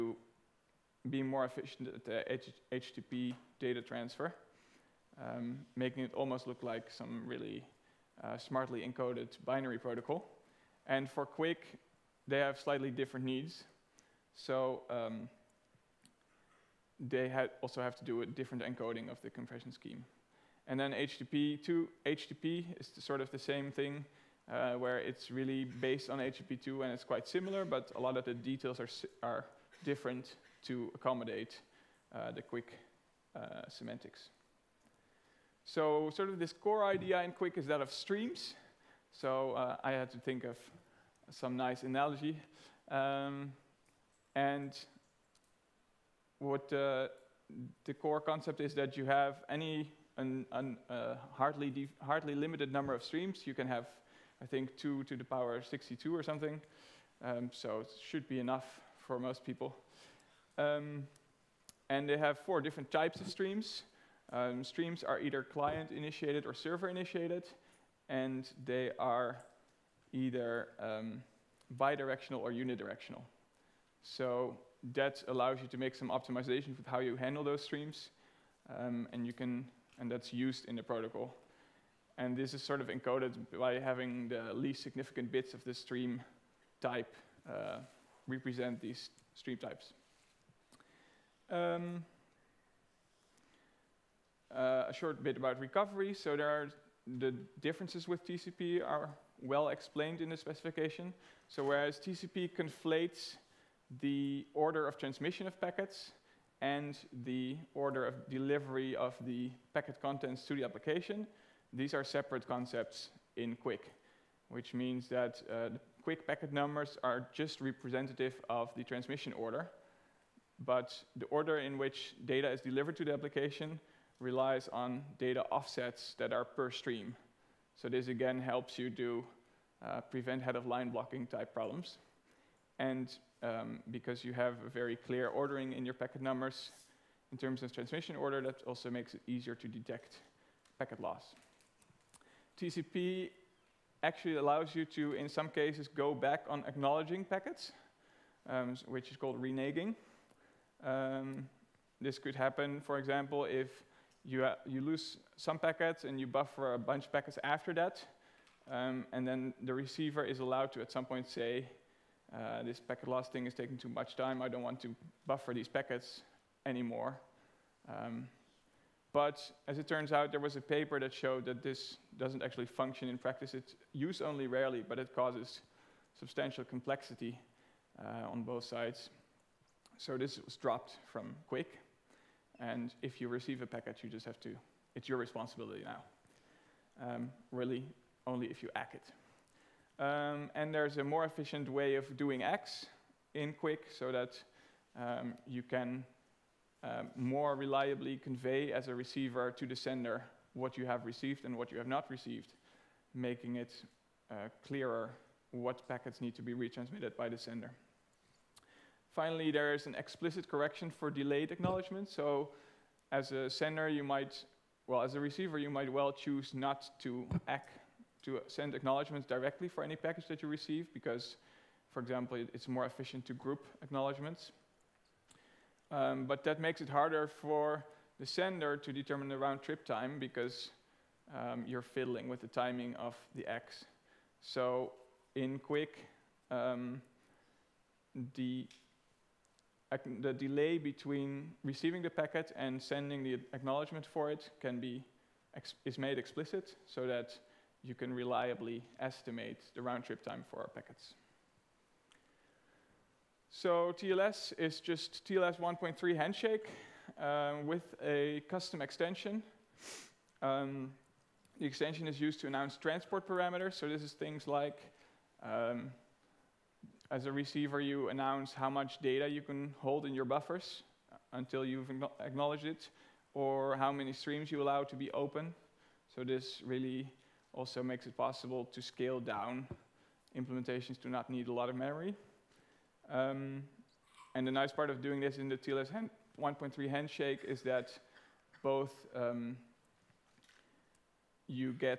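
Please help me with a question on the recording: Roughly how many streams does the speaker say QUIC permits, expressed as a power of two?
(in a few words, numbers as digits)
2 to the power 62.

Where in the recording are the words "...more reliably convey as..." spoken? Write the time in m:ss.
3:17.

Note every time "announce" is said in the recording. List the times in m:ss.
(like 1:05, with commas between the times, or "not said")
4:22, 4:28.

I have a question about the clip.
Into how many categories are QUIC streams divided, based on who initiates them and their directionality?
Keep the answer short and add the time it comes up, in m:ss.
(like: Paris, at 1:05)
4, at 1:02.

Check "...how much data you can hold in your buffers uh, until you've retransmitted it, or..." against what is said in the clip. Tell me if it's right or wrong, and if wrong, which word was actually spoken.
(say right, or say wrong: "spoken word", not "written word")
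wrong: "acknowledged", not "retransmitted".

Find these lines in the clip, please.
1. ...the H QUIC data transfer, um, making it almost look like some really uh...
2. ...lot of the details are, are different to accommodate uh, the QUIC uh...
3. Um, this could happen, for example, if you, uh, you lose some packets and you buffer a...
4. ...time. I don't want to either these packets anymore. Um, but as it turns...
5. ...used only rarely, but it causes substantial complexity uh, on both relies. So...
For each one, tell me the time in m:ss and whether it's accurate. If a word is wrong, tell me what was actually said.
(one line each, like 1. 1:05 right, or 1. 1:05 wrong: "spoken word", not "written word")
1. 0:02 wrong: "HTTP", not "QUIC"
2. 0:27 right
3. 2:30 right
4. 2:44 wrong: "buffer", not "either"
5. 2:53 wrong: "sides", not "relies".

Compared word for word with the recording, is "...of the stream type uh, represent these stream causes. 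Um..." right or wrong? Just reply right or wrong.
wrong.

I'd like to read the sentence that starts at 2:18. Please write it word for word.
That also makes it easier to detect packet loss.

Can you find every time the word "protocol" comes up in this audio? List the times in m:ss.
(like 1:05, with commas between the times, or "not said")
0:09, 1:20.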